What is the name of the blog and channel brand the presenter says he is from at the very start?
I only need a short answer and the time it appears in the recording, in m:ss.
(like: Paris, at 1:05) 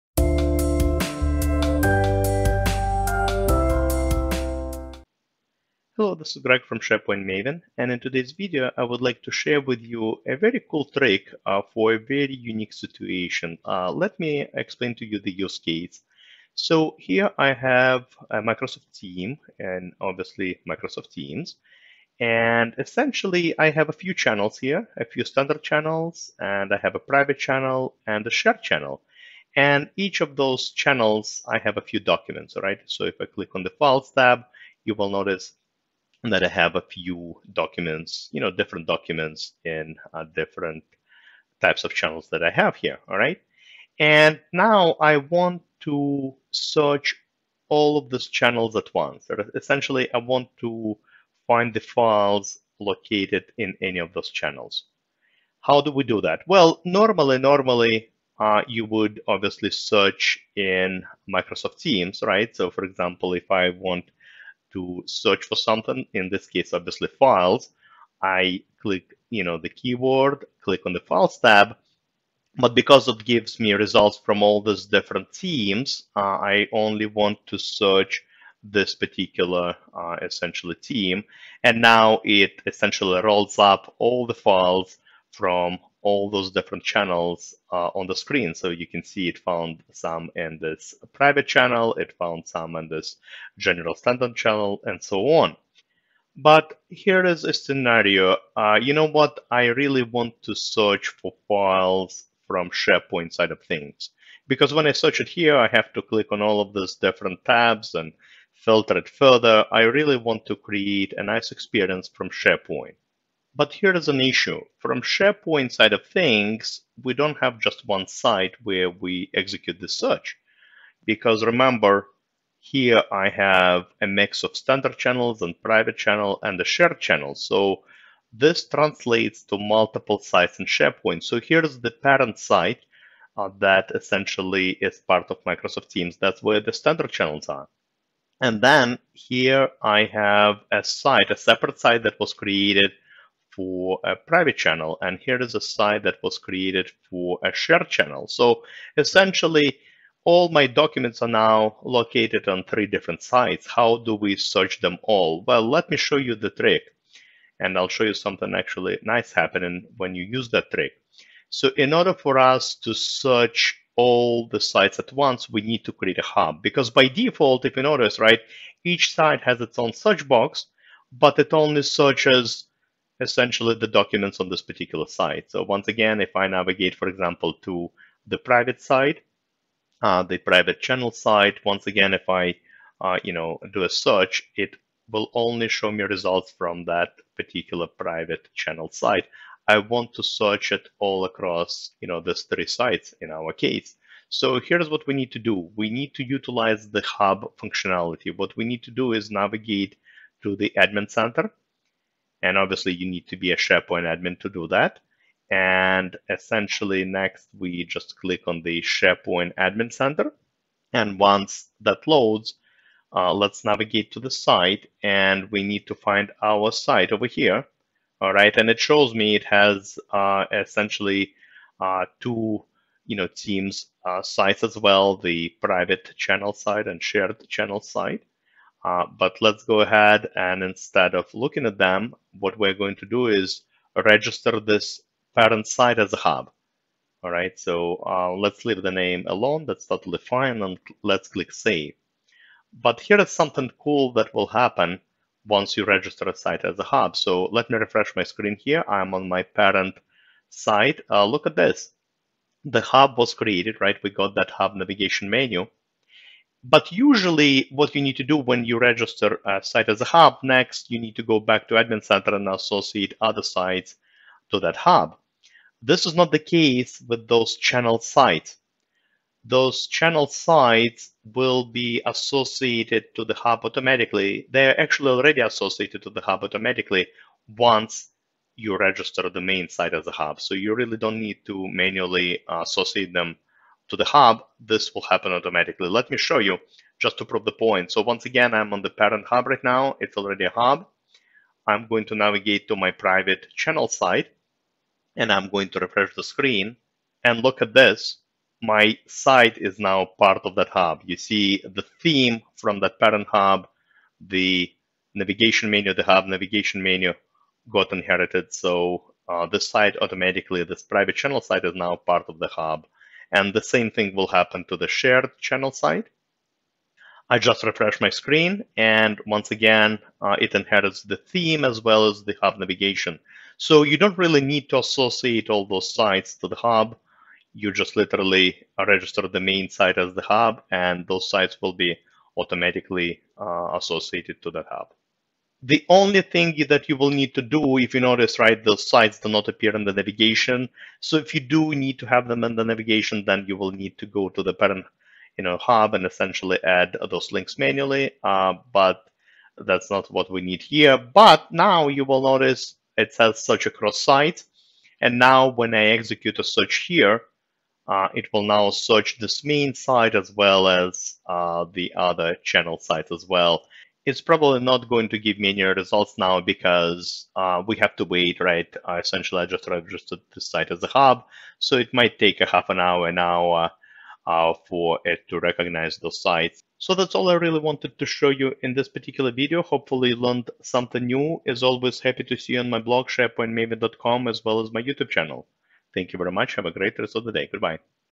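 SharePoint Maven, at 0:06.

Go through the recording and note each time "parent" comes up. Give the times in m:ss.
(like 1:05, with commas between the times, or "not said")
2:11, 3:55, 4:09, 4:48, 5:02, 5:44.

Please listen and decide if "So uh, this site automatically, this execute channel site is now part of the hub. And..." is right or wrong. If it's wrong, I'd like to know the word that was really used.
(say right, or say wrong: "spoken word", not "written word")
wrong: "private", not "execute".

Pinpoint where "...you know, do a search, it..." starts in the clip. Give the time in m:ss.
3:03.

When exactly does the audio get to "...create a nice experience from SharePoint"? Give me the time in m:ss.
1:50.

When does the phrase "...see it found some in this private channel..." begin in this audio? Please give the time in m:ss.
1:29.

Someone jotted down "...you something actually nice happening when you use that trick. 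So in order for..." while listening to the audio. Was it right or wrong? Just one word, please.
right.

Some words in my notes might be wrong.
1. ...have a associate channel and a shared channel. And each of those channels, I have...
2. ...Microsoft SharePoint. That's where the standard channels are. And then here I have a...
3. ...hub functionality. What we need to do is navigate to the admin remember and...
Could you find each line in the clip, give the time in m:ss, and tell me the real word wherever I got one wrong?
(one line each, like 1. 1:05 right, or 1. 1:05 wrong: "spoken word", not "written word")
1. 0:26 wrong: "private", not "associate"
2. 2:15 wrong: "Teams", not "SharePoint"
3. 3:17 wrong: "center", not "remember".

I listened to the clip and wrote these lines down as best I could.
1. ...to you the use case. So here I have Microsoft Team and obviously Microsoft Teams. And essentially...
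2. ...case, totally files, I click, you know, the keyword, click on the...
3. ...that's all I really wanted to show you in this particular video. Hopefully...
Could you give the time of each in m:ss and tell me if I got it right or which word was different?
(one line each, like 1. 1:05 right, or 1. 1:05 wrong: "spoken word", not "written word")
1. 0:14 right
2. 1:06 wrong: "obviously", not "totally"
3. 6:16 right.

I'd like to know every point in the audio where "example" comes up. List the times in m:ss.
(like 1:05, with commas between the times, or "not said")
1:02, 2:57.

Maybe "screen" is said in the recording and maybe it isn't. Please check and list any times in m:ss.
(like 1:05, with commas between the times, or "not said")
1:28, 4:08, 4:56, 5:18.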